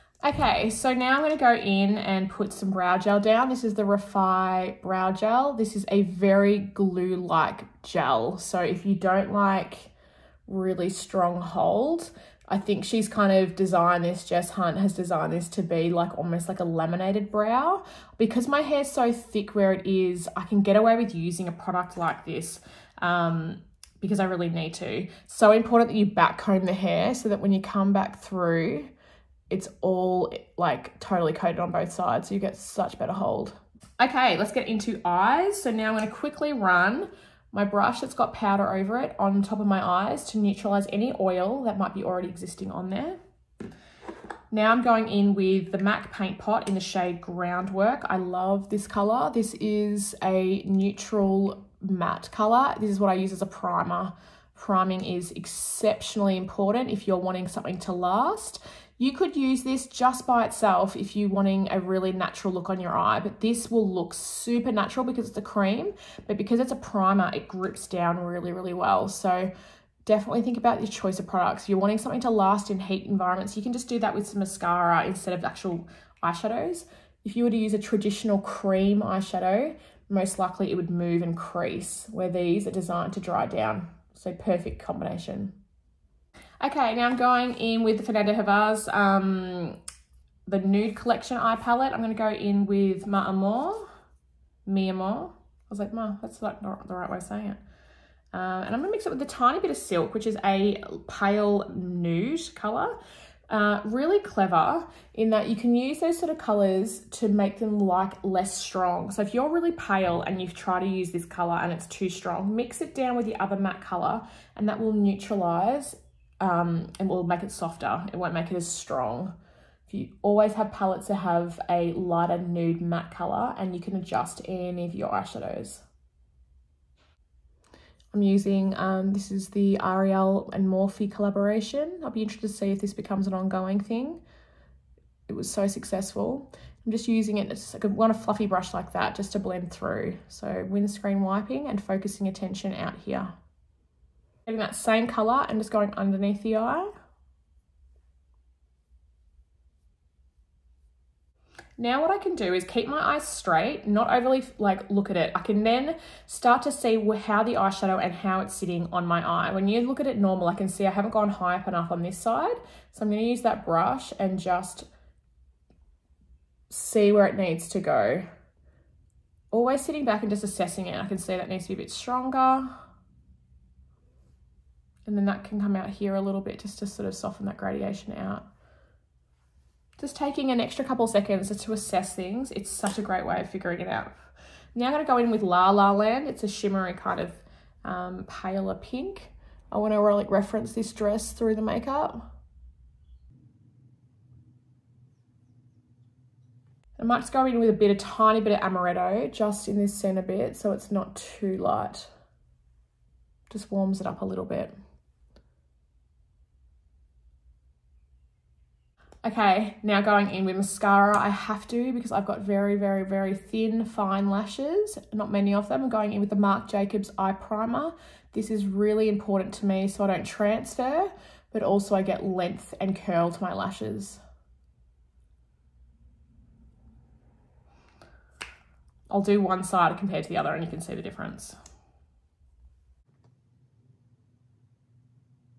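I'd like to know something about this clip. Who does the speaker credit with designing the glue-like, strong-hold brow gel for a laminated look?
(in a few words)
Jess Hunt.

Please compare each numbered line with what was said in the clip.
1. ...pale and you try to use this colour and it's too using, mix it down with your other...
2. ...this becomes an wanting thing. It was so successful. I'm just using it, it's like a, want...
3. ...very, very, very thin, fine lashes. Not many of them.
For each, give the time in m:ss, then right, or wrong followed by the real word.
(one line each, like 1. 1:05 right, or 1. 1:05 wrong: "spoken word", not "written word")
1. 1:49 wrong: "strong", not "using"
2. 2:12 wrong: "ongoing", not "wanting"
3. 3:32 right.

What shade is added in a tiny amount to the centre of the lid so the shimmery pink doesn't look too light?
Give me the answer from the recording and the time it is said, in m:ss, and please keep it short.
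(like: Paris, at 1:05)
Amaretto, at 3:18.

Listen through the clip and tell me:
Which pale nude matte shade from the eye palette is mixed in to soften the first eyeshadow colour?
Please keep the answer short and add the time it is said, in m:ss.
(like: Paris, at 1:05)
Silk, at 1:39.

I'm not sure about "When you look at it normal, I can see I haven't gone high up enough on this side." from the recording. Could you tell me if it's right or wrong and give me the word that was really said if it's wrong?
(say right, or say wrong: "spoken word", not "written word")
right.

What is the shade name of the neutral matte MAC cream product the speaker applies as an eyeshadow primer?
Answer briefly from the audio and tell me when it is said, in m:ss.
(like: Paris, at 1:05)
Groundwork, at 0:47.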